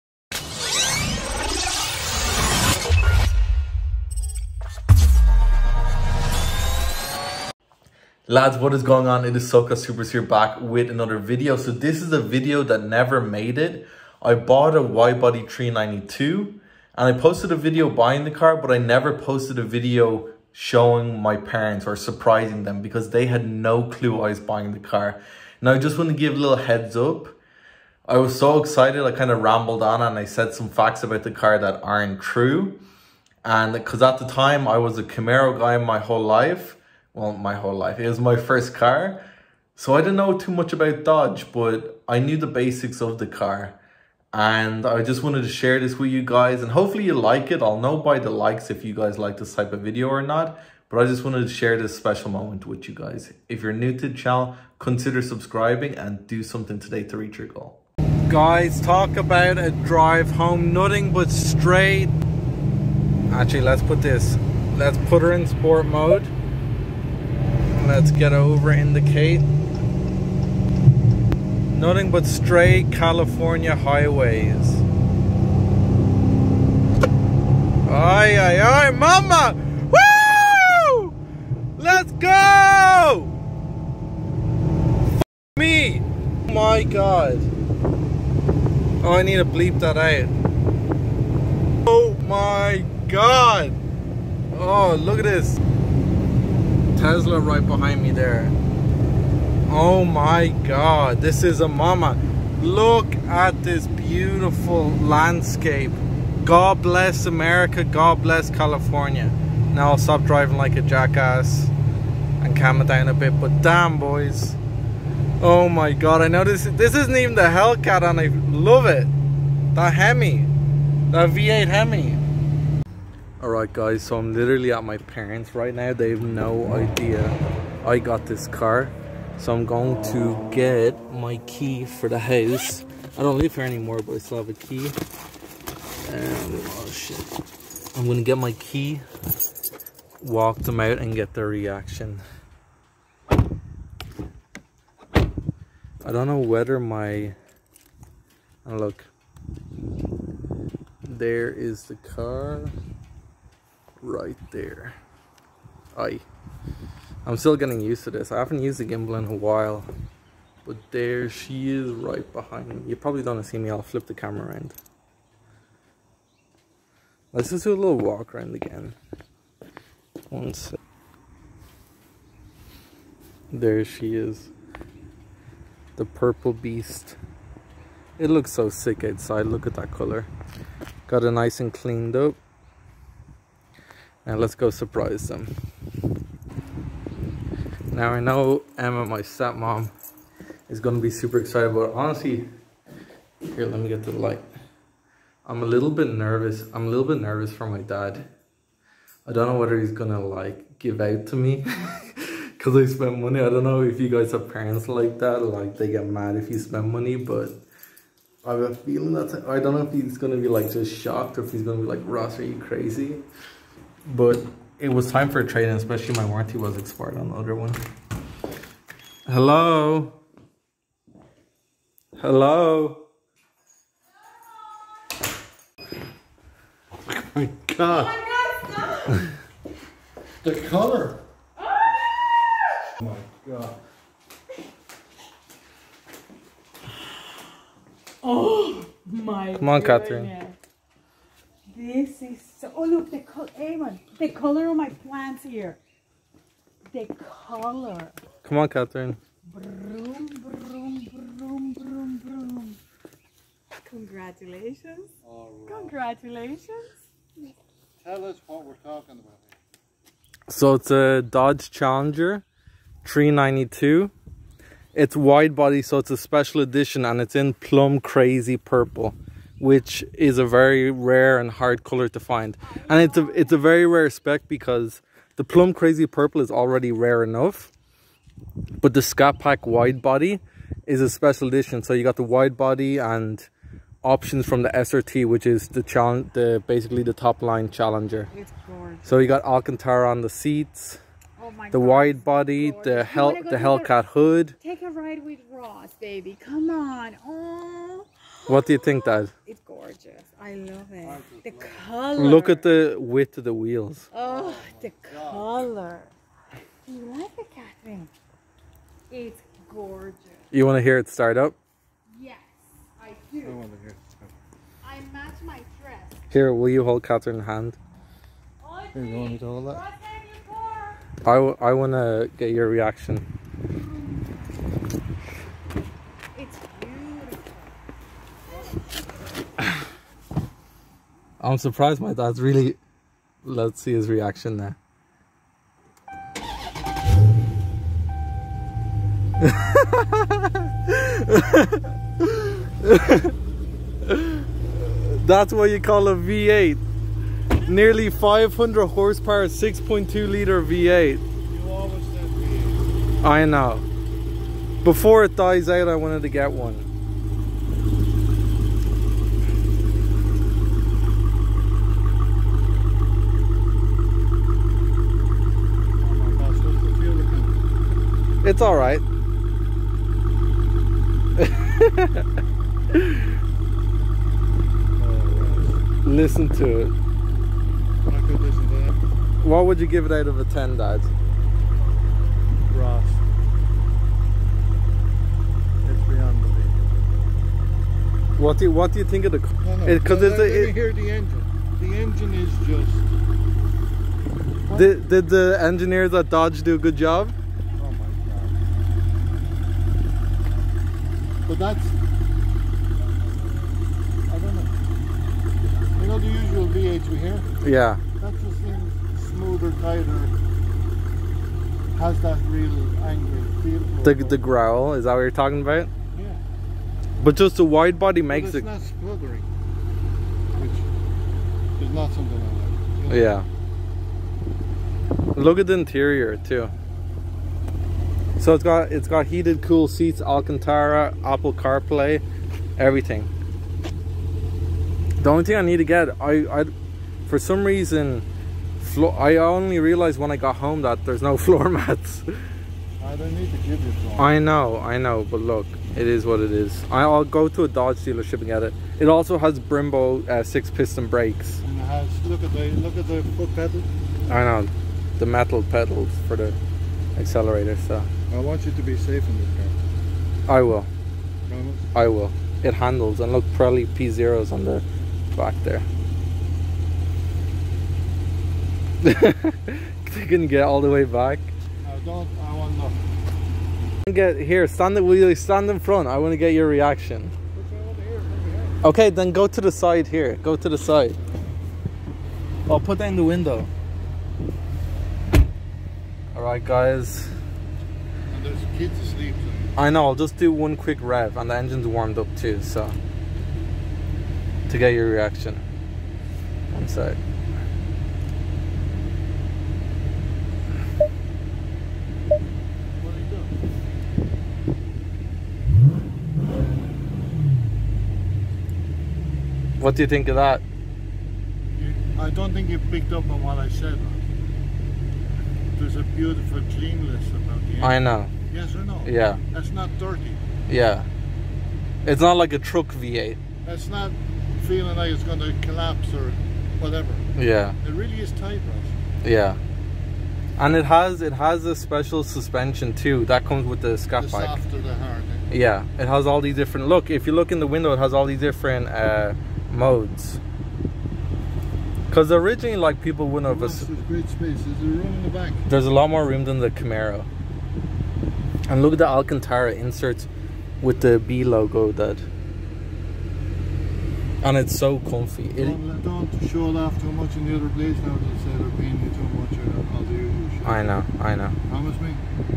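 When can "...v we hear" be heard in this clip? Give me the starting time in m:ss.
6:46.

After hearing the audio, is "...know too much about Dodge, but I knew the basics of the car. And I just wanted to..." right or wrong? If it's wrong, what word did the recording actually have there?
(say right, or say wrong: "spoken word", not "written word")
right.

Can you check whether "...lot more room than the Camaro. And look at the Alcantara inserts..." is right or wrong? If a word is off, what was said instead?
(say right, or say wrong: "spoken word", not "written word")
right.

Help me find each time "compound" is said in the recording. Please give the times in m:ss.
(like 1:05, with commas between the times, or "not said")
not said.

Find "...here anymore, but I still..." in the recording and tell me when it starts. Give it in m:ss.
2:13.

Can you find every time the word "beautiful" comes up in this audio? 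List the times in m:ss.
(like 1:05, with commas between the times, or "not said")
1:43, 8:36.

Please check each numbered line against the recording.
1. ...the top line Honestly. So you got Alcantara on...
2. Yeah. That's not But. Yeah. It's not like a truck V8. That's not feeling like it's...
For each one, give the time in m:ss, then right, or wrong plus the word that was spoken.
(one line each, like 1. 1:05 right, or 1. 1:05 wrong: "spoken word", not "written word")
1. 4:47 wrong: "Challenger", not "Honestly"
2. 8:39 wrong: "Turkey", not "But".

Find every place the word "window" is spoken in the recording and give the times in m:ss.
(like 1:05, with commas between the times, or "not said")
8:03, 8:57.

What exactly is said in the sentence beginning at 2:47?
Let's just do a little walk around again.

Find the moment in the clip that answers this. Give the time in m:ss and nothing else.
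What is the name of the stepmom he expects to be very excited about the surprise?
3:08.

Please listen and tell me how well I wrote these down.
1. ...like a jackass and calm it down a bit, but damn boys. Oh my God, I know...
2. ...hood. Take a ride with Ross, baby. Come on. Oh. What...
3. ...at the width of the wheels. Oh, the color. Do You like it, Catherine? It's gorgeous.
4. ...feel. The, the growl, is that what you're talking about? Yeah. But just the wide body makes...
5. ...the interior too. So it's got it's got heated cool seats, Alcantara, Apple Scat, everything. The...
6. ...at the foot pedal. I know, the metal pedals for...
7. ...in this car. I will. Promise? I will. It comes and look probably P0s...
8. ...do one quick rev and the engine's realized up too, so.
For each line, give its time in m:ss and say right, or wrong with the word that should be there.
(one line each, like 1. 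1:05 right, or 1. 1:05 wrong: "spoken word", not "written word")
1. 1:50 right
2. 4:54 right
3. 5:02 right
4. 6:53 right
5. 7:05 wrong: "CarPlay", not "Scat"
6. 7:32 right
7. 7:39 wrong: "handles", not "comes"
8. 8:10 wrong: "warmed", not "realized".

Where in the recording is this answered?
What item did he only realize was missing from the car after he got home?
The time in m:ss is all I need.
7:21.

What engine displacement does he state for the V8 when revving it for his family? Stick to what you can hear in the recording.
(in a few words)
6.2 liter.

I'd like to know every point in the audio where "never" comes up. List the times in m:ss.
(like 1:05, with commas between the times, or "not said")
0:12, 0:18.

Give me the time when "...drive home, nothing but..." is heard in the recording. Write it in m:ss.
0:59.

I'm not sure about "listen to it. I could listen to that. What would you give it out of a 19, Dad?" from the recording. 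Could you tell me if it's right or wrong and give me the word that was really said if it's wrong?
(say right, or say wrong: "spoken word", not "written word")
wrong: "10", not "19".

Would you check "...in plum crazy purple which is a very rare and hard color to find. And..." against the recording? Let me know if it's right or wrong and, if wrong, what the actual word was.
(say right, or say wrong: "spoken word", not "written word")
right.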